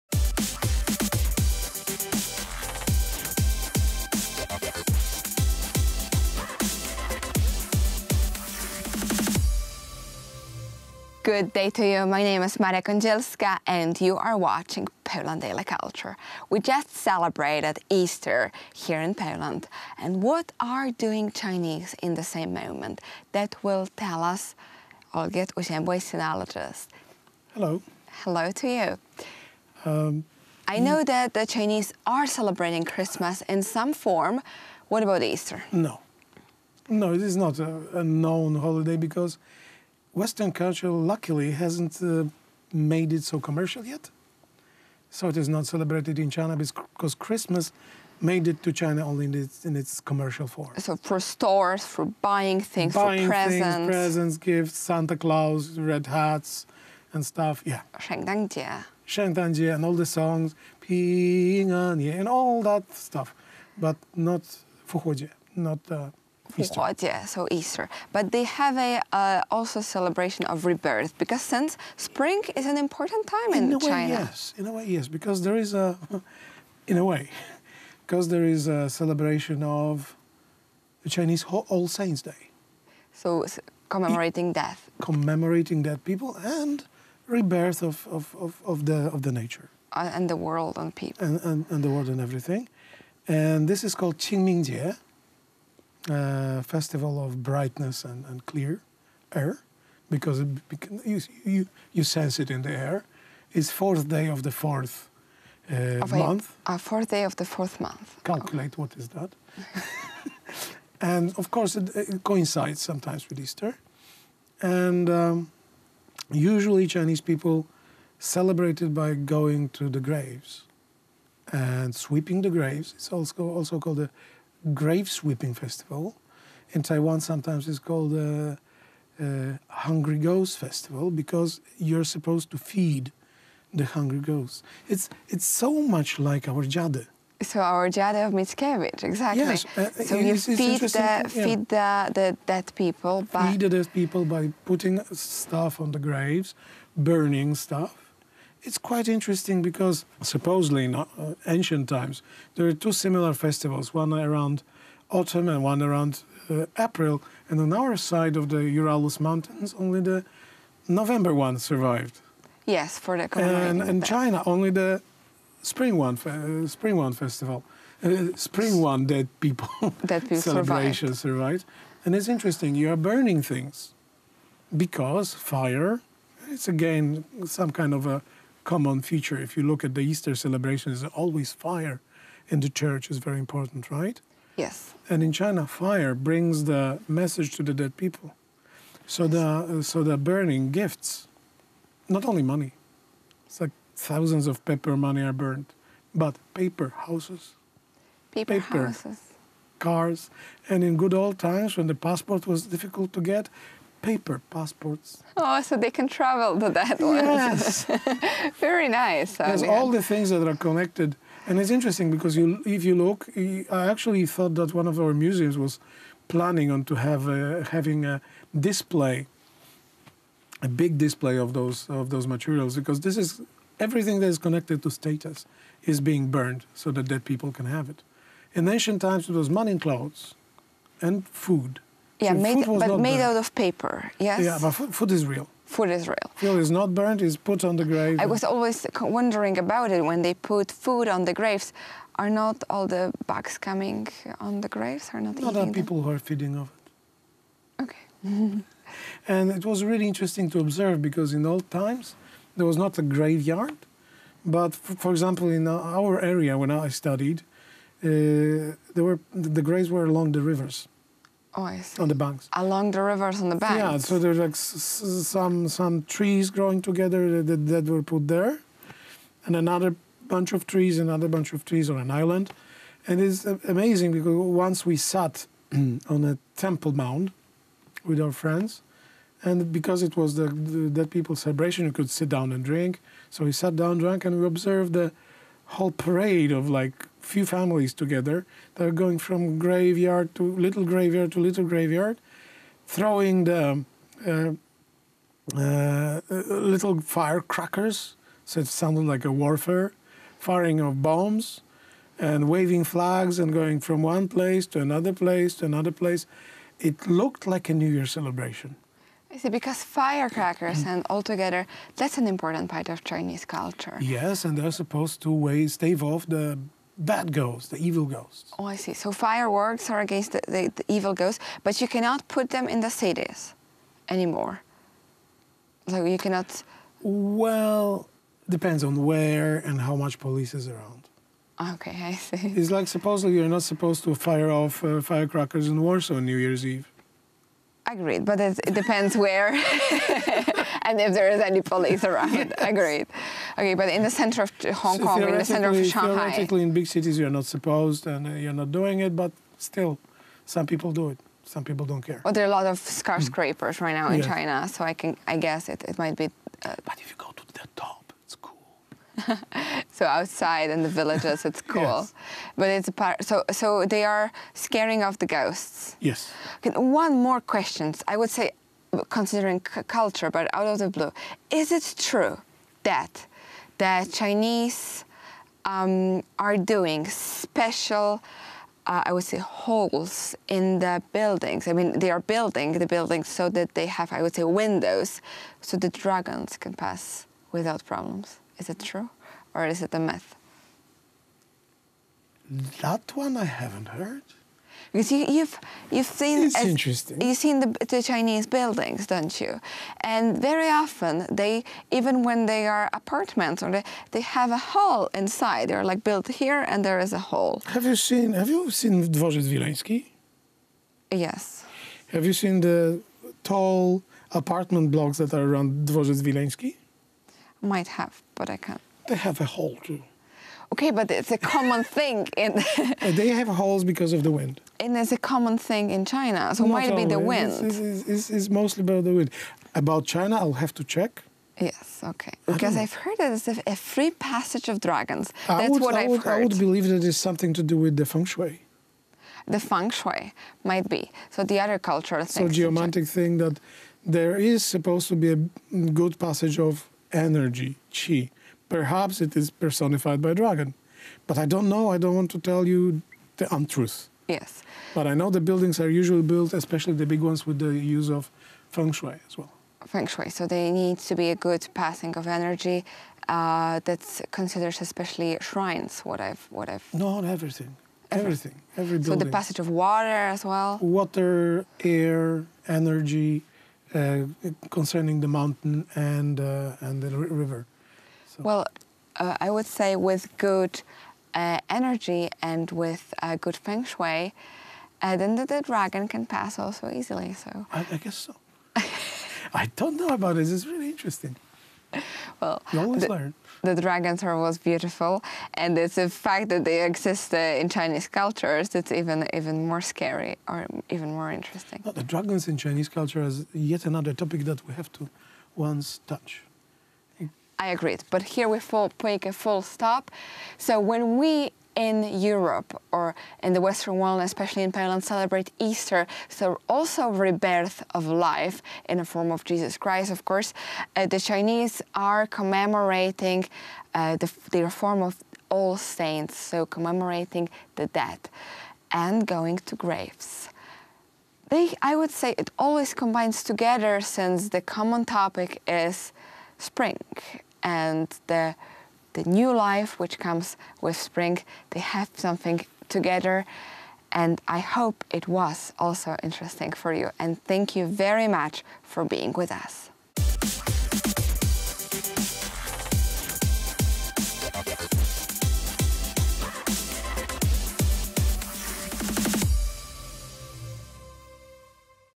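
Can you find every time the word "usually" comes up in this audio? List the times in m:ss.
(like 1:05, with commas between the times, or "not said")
1:56, 7:36.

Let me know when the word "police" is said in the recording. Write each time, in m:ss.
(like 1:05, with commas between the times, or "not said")
5:30, 5:41.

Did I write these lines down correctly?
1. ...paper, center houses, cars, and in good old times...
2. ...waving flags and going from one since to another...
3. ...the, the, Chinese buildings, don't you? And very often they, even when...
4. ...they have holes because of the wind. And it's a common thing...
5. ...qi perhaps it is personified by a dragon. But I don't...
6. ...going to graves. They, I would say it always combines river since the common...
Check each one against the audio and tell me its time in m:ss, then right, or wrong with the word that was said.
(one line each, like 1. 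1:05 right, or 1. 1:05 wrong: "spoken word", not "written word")
1. 3:18 wrong: "paper", not "center"
2. 5:02 wrong: "place", not "since"
3. 6:37 right
4. 7:03 right
5. 7:27 right
6. 8:49 wrong: "together", not "river".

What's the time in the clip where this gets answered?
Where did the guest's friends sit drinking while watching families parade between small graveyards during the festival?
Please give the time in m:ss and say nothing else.
4:36.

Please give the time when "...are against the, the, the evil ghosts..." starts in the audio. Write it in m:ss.
5:19.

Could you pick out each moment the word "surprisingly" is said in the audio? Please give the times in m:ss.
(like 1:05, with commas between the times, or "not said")
not said.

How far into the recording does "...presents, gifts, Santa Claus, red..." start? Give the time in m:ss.
0:53.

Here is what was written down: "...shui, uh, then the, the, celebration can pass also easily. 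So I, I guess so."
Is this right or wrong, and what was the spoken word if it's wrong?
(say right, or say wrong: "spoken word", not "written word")
wrong: "dragon", not "celebration".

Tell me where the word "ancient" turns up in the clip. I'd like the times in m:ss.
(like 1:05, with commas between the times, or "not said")
2:31, 3:48.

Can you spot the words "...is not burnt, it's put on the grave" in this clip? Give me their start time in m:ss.
3:56.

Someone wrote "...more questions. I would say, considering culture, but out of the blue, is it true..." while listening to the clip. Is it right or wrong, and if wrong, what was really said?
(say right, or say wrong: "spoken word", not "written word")
right.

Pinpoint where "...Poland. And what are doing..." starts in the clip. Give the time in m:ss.
0:19.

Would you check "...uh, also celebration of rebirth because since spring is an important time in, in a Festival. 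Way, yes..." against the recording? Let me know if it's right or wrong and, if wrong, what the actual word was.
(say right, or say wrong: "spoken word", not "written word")
wrong: "China", not "Festival".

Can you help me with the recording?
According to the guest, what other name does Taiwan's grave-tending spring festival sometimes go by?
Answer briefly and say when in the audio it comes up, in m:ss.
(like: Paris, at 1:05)
Hungry Ghost Festival, at 2:09.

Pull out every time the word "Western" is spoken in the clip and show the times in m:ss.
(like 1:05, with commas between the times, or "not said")
0:40, 8:33.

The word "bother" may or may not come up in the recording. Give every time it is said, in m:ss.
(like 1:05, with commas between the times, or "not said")
not said.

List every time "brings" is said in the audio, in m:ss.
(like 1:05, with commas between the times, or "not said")
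3:06.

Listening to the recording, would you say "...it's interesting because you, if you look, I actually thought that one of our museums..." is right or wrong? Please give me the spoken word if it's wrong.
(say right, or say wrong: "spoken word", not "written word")
right.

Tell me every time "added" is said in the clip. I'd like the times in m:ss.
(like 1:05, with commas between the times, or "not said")
not said.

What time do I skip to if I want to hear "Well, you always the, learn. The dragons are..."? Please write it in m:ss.
8:12.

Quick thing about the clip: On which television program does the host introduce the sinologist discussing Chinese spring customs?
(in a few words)
Poland Daily Culture.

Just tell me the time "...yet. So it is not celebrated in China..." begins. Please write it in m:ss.
0:43.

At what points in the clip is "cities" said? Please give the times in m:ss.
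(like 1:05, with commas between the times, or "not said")
5:22, 5:46.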